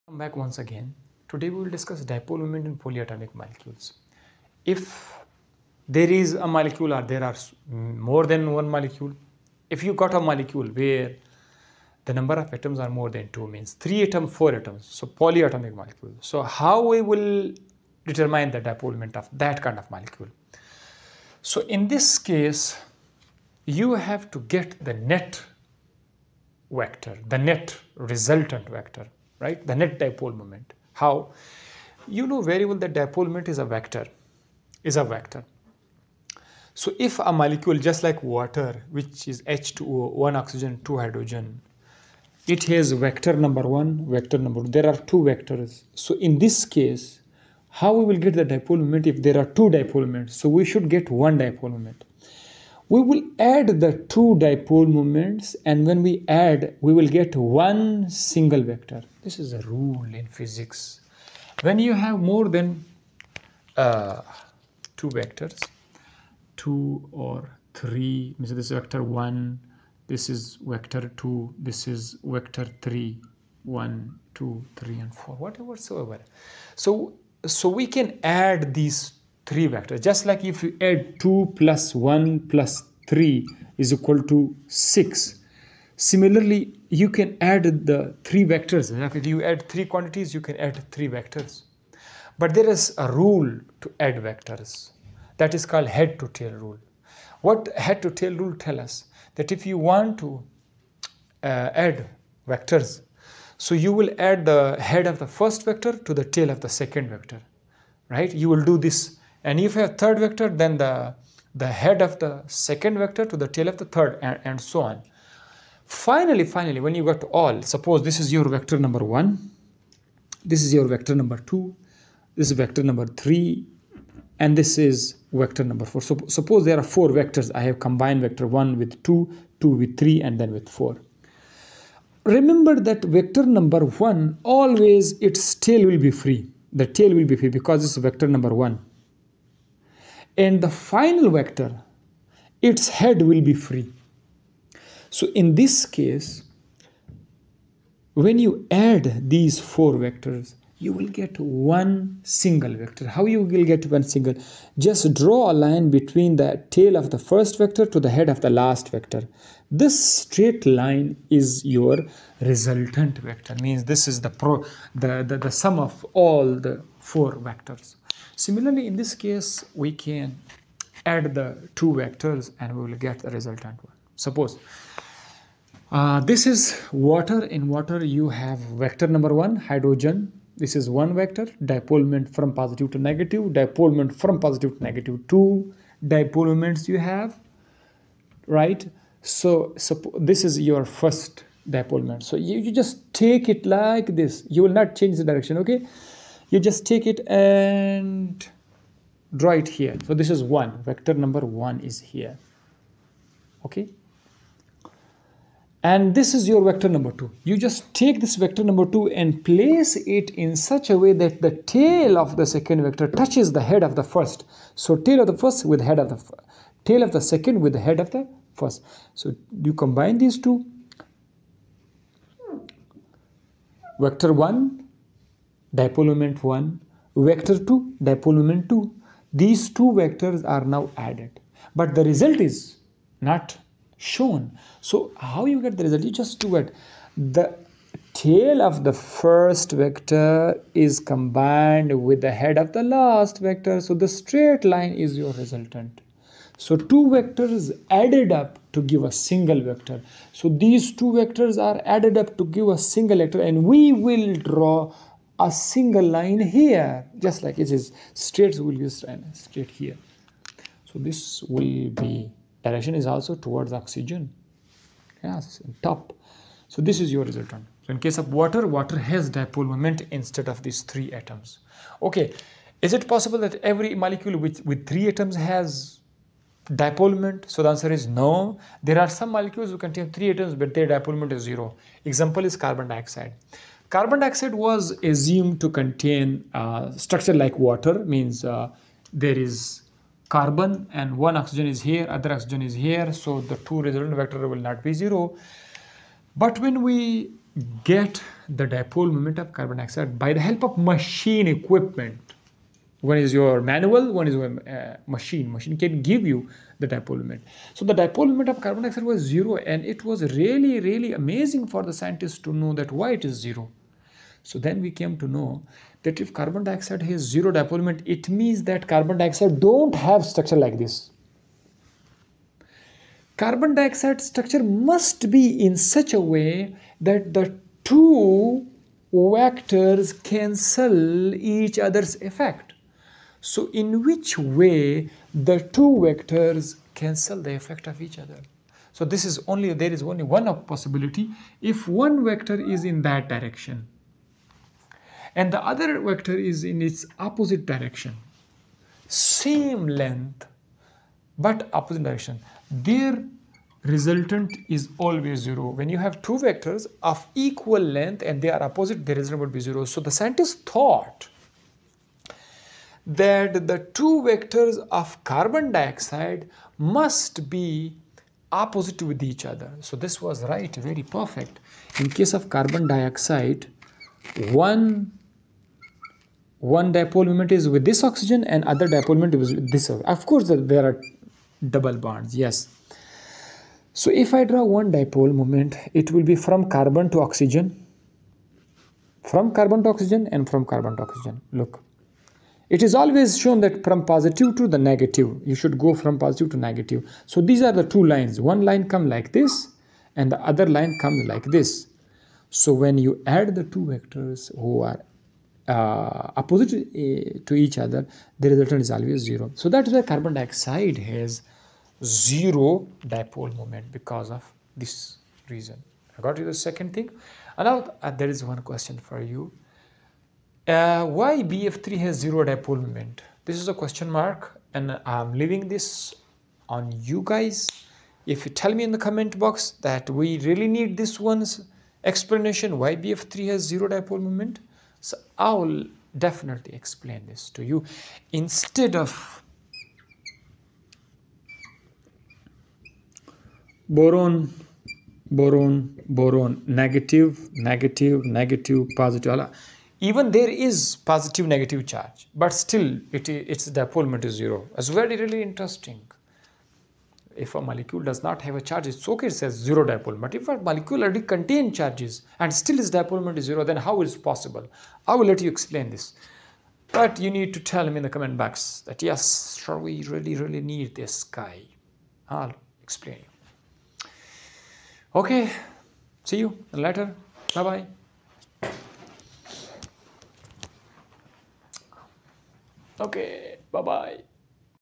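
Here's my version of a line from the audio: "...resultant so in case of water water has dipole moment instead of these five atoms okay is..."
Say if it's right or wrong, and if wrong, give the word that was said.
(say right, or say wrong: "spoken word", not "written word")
wrong: "three", not "five".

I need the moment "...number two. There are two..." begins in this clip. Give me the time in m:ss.
0:44.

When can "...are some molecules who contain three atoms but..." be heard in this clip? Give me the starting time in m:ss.
4:39.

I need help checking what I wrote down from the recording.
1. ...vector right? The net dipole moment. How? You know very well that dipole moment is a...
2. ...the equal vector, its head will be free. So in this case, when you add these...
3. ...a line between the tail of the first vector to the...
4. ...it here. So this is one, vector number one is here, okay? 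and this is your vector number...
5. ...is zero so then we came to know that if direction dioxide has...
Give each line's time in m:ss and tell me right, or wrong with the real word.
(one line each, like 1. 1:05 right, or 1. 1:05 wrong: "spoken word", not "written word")
1. 0:28 right
2. 2:20 wrong: "final", not "equal"
3. 2:35 right
4. 3:19 right
5. 5:13 wrong: "carbon", not "direction".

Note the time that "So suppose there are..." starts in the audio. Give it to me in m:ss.
2:06.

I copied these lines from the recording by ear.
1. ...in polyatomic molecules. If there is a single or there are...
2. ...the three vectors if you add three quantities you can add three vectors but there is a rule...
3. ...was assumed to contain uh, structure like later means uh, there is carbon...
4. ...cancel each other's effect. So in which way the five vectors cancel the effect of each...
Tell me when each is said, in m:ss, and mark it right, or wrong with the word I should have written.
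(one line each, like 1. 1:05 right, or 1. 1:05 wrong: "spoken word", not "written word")
1. 0:02 wrong: "molecule", not "single"
2. 1:27 right
3. 4:44 wrong: "water", not "later"
4. 5:30 wrong: "two", not "five".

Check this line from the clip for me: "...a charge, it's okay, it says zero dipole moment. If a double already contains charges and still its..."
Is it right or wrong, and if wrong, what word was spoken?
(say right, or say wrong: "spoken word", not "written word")
wrong: "molecule", not "double".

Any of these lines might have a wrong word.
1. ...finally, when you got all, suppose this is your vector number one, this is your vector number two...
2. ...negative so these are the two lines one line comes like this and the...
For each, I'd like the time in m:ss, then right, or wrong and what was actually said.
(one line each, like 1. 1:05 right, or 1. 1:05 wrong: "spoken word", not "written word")
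1. 1:56 right
2. 6:36 right.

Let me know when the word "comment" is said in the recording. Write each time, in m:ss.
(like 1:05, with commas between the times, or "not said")
7:09, 7:48.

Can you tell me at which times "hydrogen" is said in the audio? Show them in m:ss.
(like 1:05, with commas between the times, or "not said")
0:40, 2:59.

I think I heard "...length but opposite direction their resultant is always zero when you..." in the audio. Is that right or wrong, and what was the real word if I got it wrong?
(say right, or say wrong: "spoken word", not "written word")
right.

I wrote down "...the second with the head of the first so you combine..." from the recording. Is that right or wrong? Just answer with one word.
right.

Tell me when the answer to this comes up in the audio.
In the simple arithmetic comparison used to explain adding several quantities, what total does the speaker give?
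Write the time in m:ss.
1:24.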